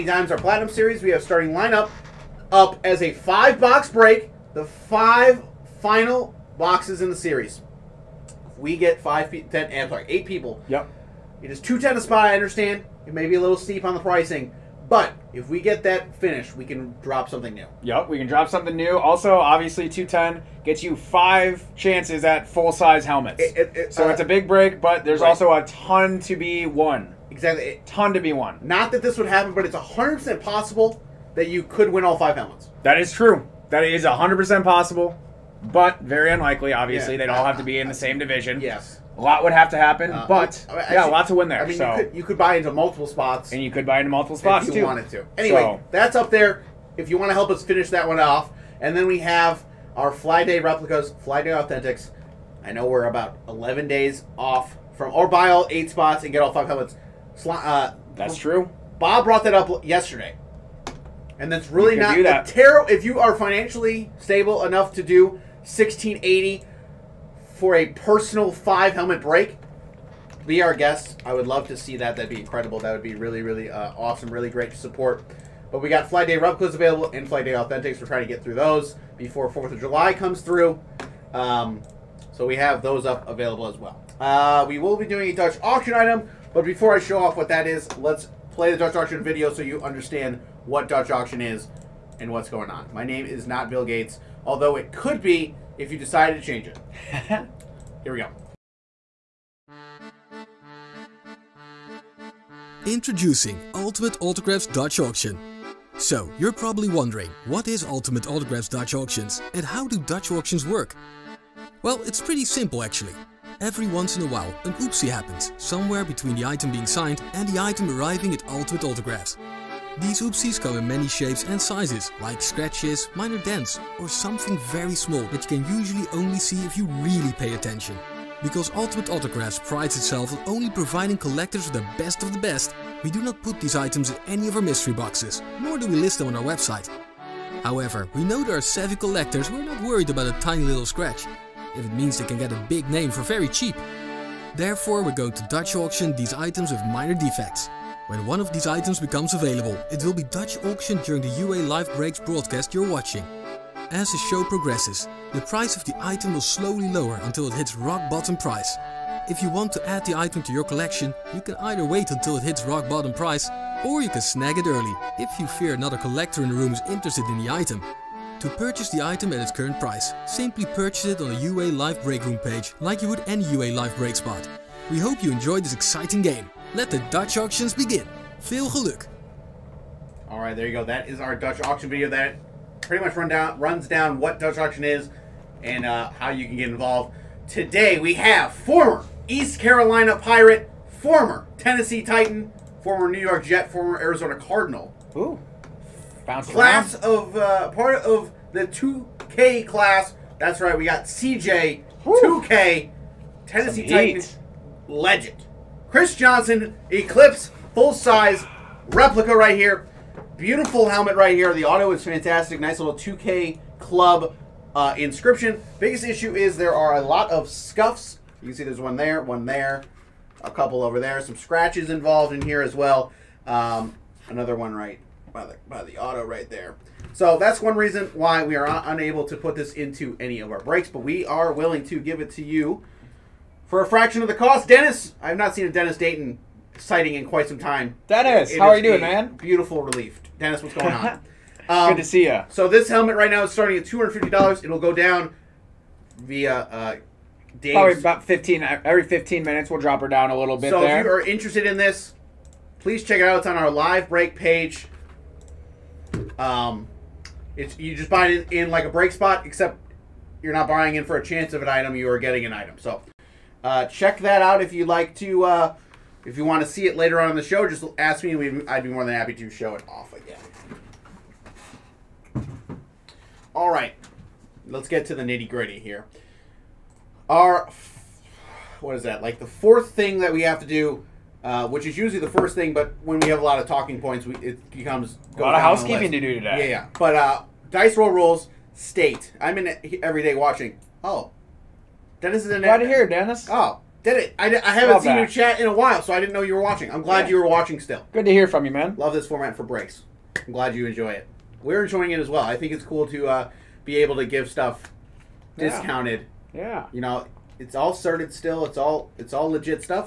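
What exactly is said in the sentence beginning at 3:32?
Nice little 2K club uh, inscription.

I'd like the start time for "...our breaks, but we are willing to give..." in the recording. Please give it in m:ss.
3:50.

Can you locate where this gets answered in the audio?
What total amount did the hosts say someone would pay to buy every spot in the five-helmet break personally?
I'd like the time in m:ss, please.
1:05.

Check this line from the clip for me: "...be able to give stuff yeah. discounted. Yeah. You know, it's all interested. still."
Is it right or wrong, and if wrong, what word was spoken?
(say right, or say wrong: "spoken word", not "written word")
wrong: "sorted", not "interested".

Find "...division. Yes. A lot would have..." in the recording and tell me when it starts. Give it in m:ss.
0:38.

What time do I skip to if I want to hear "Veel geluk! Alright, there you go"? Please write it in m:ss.
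2:58.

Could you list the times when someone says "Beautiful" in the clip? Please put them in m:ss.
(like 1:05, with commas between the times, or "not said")
3:30, 3:59.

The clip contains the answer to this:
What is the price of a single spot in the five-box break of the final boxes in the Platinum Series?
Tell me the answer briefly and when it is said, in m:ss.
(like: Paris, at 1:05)
$210, at 0:11.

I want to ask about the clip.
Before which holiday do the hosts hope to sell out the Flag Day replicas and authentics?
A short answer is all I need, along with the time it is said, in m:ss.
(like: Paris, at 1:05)
Fourth of July, at 1:19.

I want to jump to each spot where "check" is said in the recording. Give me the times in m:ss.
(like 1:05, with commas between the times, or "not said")
4:13, 4:23.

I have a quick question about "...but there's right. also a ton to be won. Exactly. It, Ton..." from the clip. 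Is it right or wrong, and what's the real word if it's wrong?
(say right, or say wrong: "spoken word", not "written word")
right.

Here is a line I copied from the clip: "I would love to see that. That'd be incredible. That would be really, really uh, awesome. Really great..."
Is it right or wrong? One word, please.
right.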